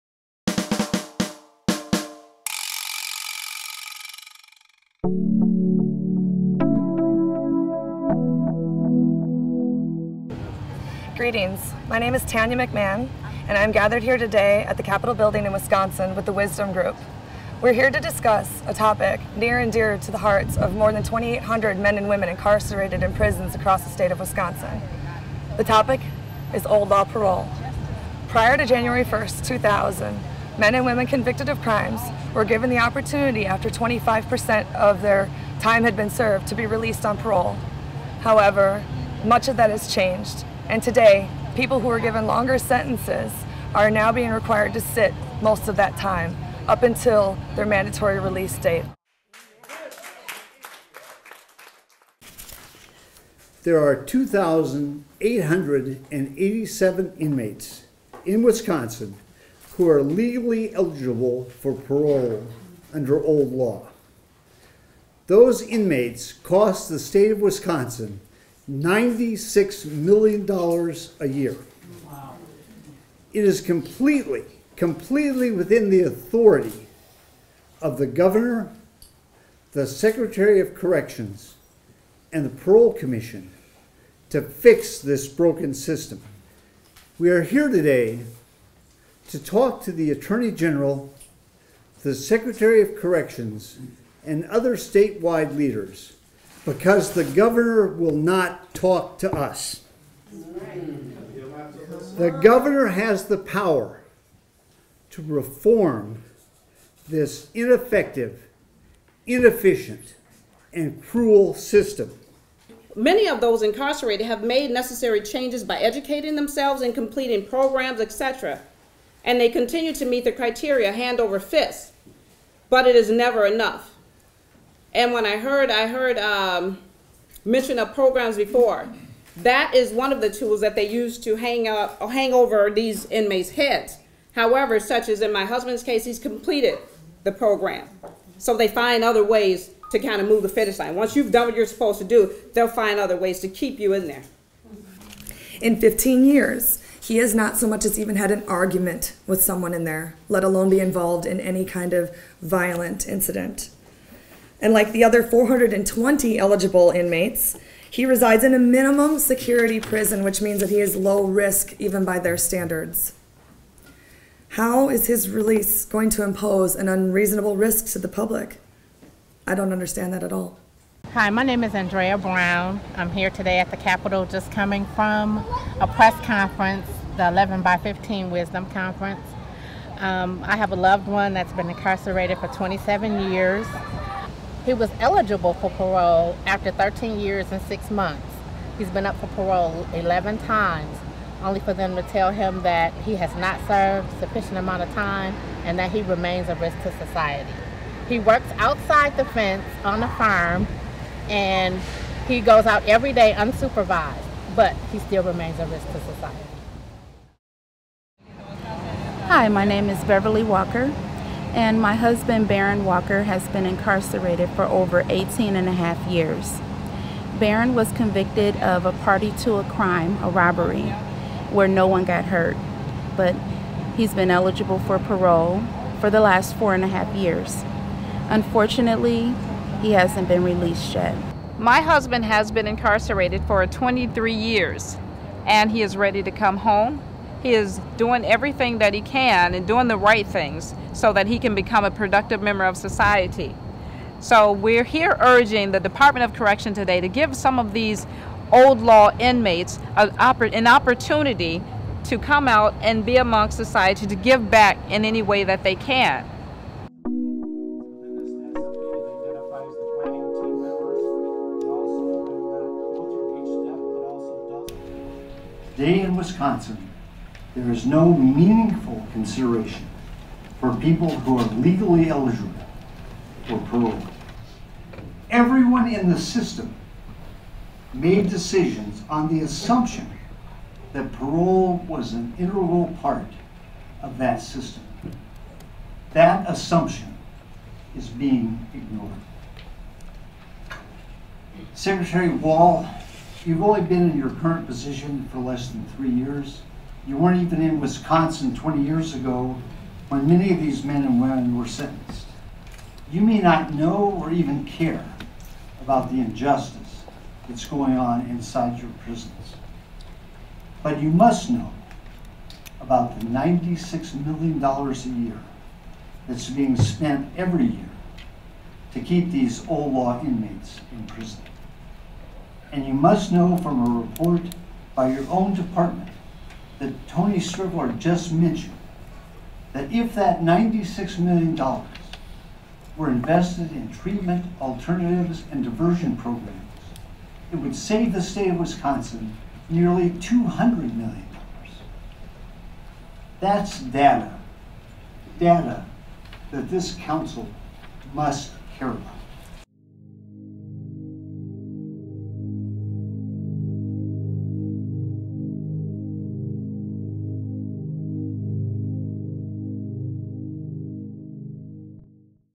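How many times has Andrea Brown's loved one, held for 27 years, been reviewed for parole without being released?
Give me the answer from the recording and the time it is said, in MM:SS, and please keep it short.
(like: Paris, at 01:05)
11, at 03:09.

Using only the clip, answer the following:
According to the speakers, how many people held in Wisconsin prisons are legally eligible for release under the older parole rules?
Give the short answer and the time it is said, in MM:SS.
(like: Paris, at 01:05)
2,887, at 00:53.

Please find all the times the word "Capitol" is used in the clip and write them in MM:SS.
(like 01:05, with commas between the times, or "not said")
00:14, 02:53.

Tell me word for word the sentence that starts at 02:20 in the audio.
Once you've done what you're supposed to do, they'll find other ways to keep you in there.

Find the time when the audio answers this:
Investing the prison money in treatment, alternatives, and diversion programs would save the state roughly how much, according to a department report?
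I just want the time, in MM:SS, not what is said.
05:40.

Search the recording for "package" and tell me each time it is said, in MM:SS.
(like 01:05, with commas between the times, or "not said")
not said.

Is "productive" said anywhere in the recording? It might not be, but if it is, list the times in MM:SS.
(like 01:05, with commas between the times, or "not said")
04:01.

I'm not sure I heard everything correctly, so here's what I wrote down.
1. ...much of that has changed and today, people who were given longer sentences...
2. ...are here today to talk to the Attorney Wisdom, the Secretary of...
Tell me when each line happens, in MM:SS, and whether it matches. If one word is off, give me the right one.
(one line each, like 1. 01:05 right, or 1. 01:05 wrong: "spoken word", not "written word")
1. 00:39 right
2. 01:27 wrong: "General", not "Wisdom".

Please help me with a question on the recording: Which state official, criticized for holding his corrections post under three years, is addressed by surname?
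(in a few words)
Wall.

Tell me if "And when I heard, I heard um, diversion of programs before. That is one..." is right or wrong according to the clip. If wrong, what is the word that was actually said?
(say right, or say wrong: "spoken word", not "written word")
wrong: "mention", not "diversion".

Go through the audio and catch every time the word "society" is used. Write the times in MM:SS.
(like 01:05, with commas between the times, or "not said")
03:16, 03:26, 04:02, 04:13.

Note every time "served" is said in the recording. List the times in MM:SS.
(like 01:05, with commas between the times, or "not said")
00:36, 03:13.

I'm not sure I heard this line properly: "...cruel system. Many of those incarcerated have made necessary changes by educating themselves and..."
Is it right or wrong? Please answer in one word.
right.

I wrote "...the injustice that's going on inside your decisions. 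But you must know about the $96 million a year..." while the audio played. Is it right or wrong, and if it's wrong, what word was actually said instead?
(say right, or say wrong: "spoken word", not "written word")
wrong: "prisons", not "decisions".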